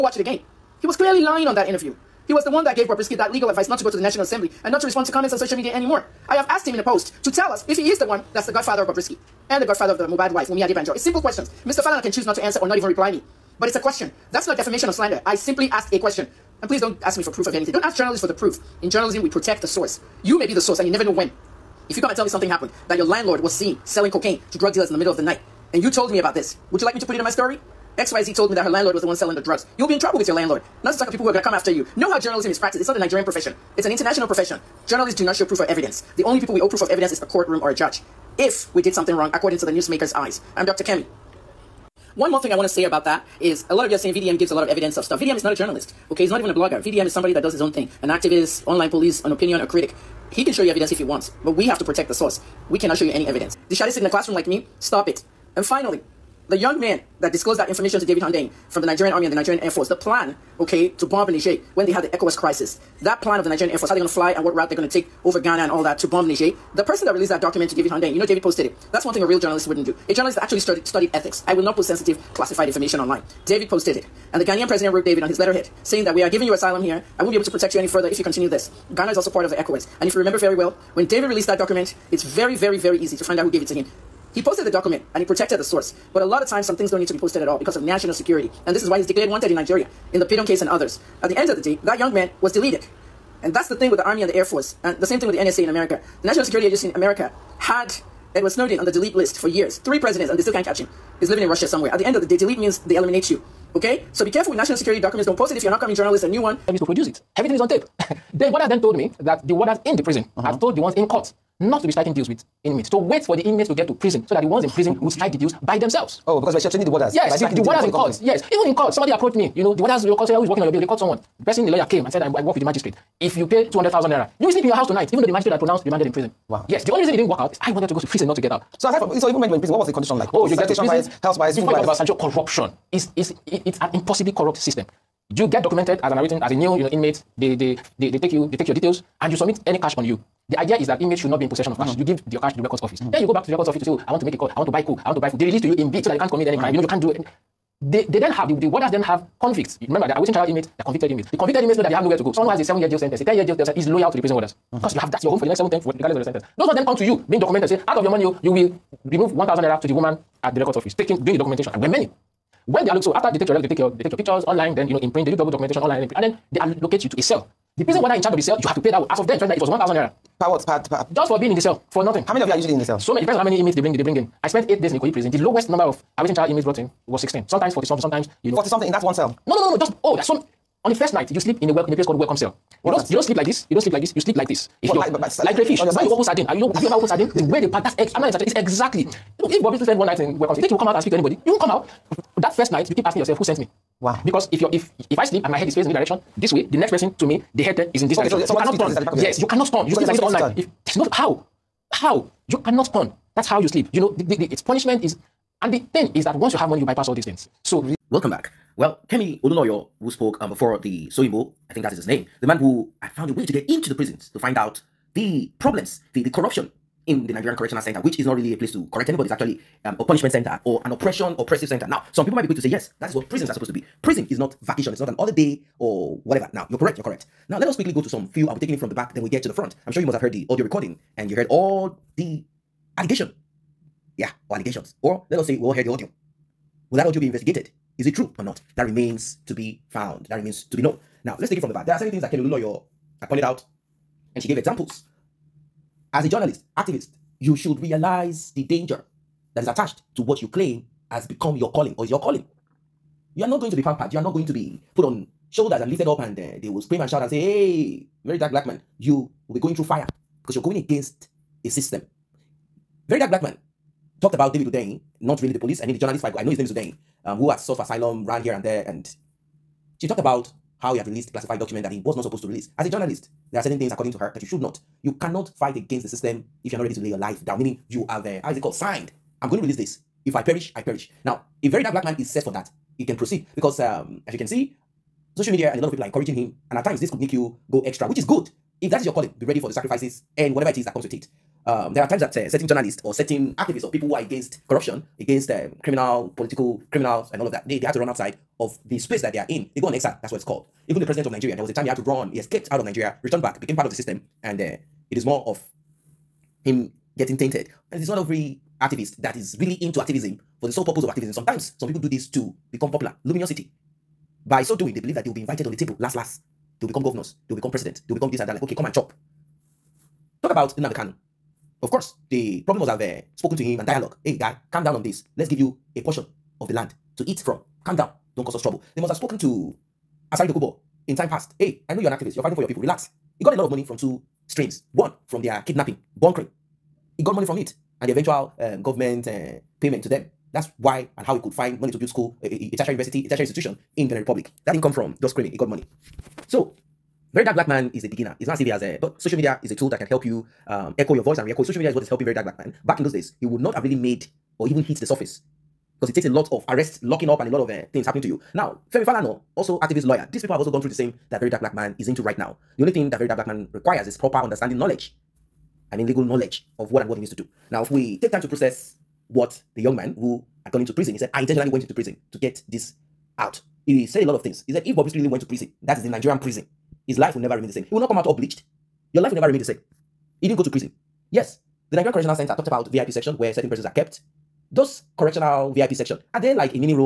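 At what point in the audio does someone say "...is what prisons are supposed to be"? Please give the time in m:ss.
3:43.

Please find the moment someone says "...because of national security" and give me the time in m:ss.
1:27.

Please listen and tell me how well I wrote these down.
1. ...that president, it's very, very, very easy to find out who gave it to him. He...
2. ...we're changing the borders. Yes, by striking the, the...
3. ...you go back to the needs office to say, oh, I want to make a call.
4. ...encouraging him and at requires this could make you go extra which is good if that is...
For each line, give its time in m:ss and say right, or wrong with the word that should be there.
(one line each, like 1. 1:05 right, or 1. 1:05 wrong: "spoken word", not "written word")
1. 1:21 wrong: "document", not "president"
2. 1:56 right
3. 2:23 wrong: "records", not "needs"
4. 4:46 wrong: "times", not "requires".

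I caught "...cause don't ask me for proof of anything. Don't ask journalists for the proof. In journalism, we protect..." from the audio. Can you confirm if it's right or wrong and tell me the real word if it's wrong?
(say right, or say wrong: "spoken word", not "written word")
wrong: "please", not "cause".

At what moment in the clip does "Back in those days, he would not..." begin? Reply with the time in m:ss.
5:52.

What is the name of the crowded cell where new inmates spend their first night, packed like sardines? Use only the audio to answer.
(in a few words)
welcome cell.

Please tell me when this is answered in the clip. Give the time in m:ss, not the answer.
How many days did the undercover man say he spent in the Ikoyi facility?
2:54.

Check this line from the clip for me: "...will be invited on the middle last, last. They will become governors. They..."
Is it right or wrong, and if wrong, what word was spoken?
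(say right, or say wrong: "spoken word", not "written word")
wrong: "table", not "middle".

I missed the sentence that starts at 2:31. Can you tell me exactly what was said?
The convicted inmates know that they have nowhere to go.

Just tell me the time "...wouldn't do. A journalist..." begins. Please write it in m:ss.
1:09.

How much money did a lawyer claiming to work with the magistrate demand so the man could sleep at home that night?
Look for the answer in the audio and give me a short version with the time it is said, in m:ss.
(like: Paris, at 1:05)
200,000 naira, at 2:03.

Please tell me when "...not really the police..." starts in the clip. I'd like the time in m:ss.
4:25.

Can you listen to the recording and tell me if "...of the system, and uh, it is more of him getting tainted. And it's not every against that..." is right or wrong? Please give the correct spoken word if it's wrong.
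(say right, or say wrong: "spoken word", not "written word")
wrong: "activist", not "against".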